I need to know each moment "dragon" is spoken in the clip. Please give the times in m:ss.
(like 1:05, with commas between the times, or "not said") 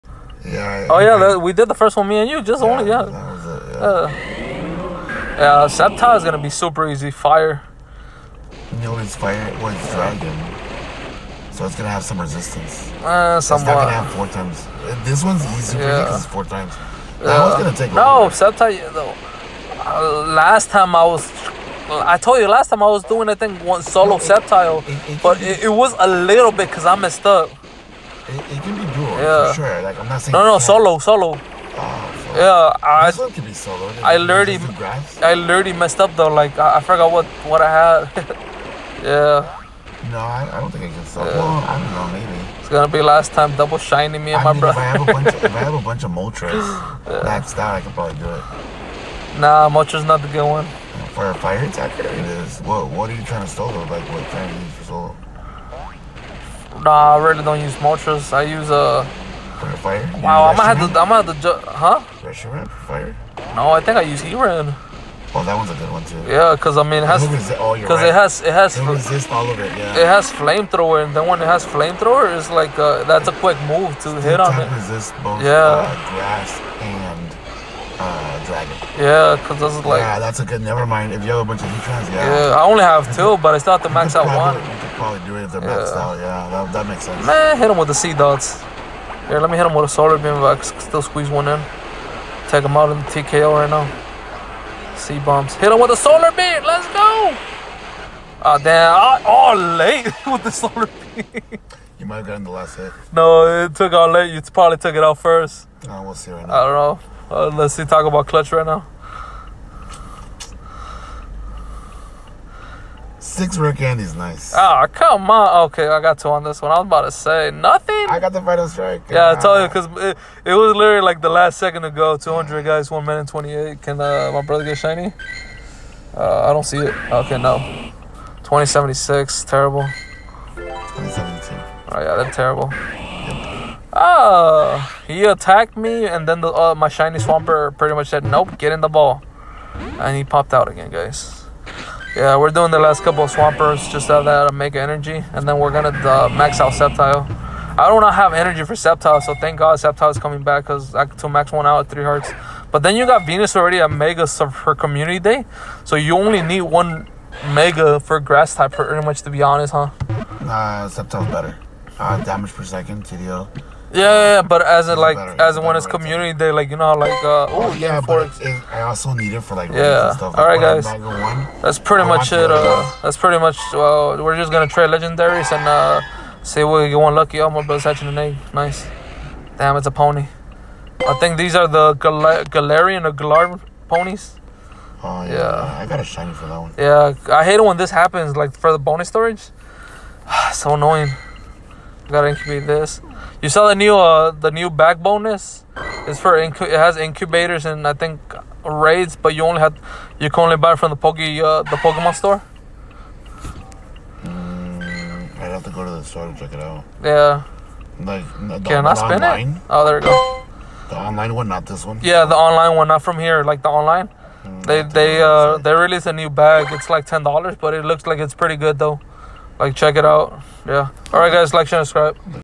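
0:09, 1:18.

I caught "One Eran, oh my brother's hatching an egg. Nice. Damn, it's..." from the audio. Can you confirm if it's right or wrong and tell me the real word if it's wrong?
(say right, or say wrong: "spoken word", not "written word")
wrong: "Lucky", not "Eran".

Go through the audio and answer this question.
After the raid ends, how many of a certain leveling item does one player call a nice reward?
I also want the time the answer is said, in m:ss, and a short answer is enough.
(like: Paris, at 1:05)
6, at 1:53.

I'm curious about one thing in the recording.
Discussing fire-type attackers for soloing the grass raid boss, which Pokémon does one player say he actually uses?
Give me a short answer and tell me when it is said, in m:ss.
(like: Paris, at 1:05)
Eran, at 1:04.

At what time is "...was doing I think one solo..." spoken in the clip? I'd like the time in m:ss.
0:22.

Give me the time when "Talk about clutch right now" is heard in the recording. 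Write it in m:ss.
1:47.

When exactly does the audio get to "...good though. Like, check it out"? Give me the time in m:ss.
3:38.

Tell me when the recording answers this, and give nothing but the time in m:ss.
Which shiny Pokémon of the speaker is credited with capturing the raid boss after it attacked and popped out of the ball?
2:17.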